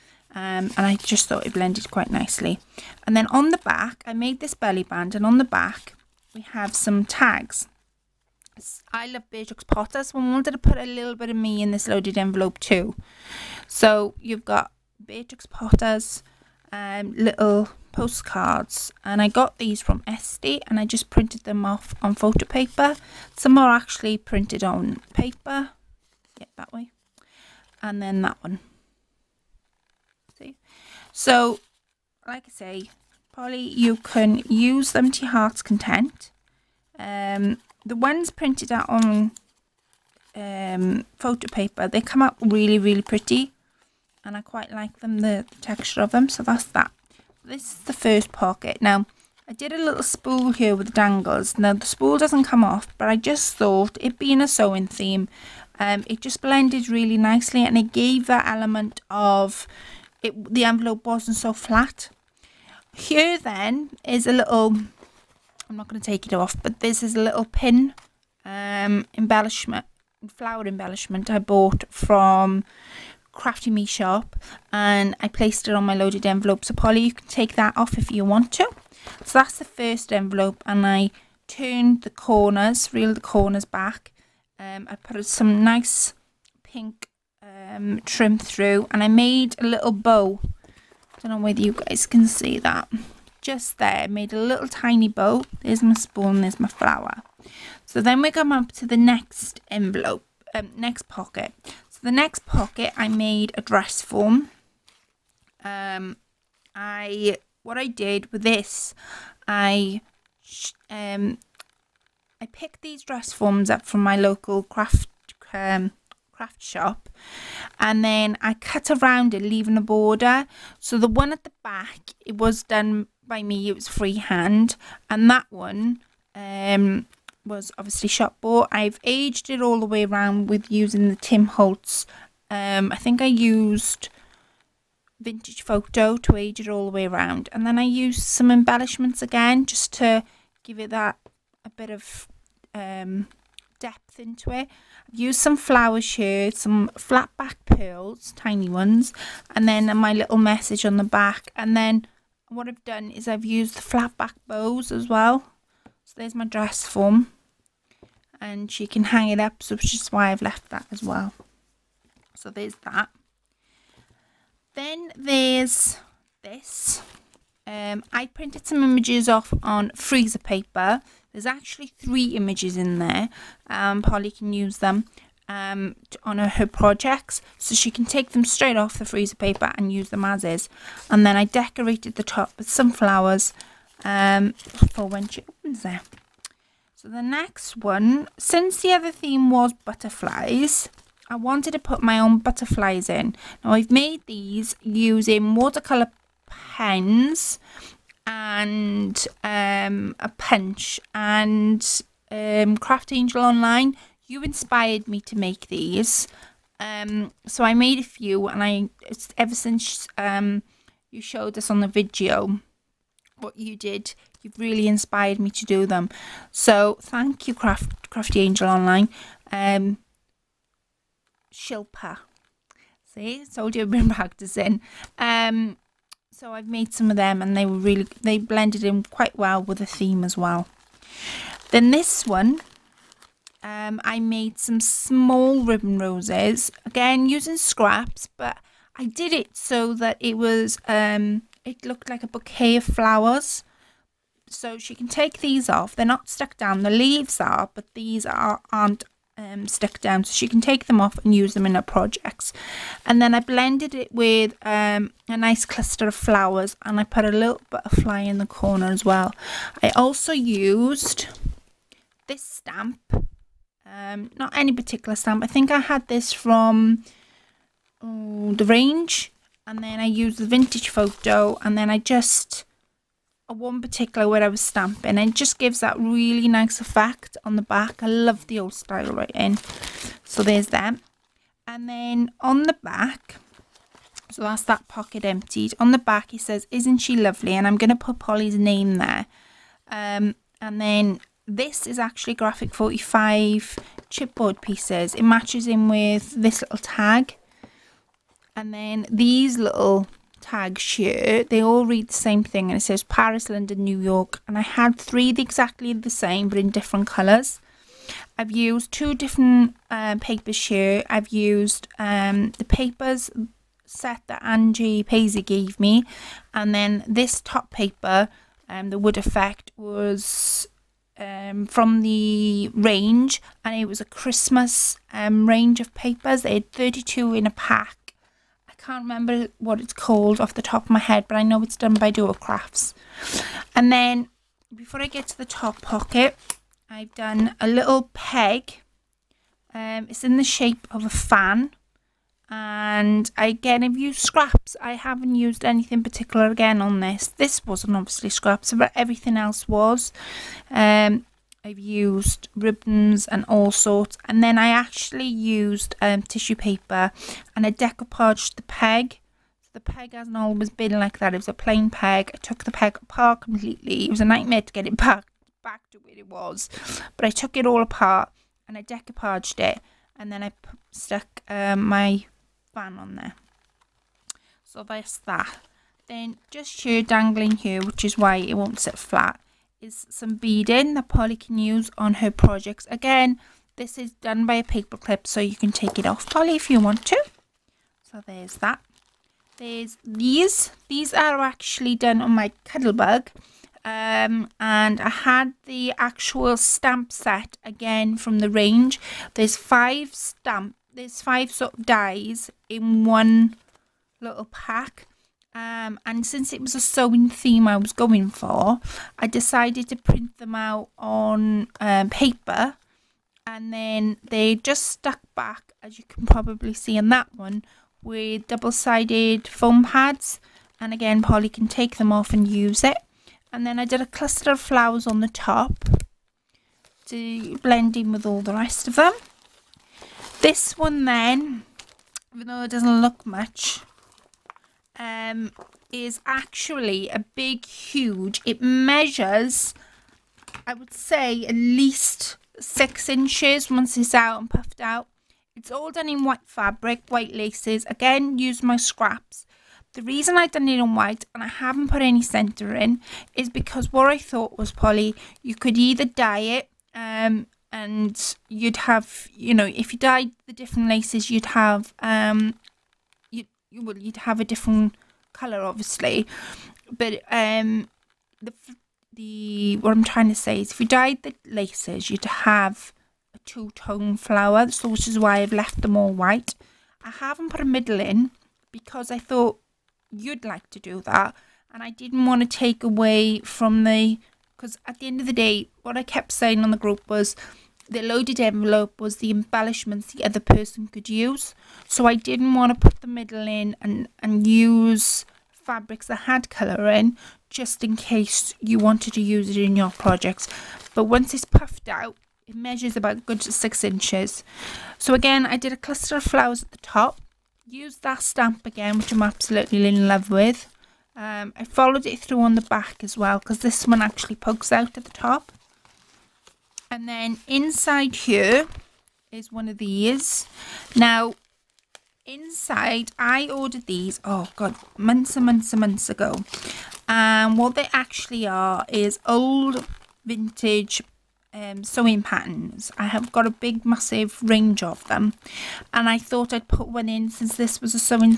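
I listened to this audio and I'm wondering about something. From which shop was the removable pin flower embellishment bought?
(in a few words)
Crafty Me.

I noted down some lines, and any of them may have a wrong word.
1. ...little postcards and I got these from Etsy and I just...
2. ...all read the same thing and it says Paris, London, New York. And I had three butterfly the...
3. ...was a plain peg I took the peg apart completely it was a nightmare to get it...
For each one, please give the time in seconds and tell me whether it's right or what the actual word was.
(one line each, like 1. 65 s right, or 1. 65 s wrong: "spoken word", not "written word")
1. 17 s right
2. 301 s wrong: "exactly", not "butterfly"
3. 361 s right.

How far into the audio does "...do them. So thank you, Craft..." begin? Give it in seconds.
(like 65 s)
215 s.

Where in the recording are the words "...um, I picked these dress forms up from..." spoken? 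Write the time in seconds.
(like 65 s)
110 s.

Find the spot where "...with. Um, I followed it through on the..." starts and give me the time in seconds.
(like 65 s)
510 s.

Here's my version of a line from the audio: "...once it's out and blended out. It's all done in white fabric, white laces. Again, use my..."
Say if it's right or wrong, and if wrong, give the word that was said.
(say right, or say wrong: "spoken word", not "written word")
wrong: "puffed", not "blended".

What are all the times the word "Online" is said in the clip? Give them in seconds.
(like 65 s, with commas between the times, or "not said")
203 s, 218 s.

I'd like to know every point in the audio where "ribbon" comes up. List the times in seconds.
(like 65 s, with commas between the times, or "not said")
235 s, 352 s.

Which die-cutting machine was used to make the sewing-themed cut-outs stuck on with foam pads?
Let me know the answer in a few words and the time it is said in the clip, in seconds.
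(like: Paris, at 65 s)
Cuttlebug, at 392 s.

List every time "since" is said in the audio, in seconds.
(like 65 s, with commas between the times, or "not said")
188 s, 209 s, 406 s, 537 s.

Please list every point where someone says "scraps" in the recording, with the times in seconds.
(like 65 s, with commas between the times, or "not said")
237 s, 344 s, 348 s, 448 s.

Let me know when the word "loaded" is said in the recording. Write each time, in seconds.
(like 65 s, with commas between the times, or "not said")
11 s, 75 s, 488 s.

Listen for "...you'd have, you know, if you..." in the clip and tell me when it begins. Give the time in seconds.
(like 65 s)
458 s.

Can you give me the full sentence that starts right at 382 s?
Again, this is done by a paper clip, so you can take it off, Polly, if you want to.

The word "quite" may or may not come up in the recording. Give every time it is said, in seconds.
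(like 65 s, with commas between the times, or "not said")
1 s, 44 s, 229 s.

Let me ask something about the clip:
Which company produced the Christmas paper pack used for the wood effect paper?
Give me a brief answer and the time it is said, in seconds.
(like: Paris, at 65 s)
Dovecrafts, at 332 s.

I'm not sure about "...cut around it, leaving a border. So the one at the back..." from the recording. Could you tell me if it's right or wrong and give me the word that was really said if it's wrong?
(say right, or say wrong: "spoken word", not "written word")
right.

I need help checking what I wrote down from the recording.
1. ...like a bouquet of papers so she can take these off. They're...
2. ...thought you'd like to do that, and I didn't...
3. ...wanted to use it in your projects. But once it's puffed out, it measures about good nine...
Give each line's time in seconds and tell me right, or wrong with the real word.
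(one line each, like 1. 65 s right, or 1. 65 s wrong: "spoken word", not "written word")
1. 242 s wrong: "flowers", not "papers"
2. 479 s right
3. 498 s wrong: "six", not "nine".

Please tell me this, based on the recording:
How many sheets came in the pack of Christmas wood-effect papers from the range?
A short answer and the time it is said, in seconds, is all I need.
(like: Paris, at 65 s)
32, at 326 s.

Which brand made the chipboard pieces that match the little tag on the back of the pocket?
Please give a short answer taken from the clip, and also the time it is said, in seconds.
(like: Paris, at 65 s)
Graphic 45, at 292 s.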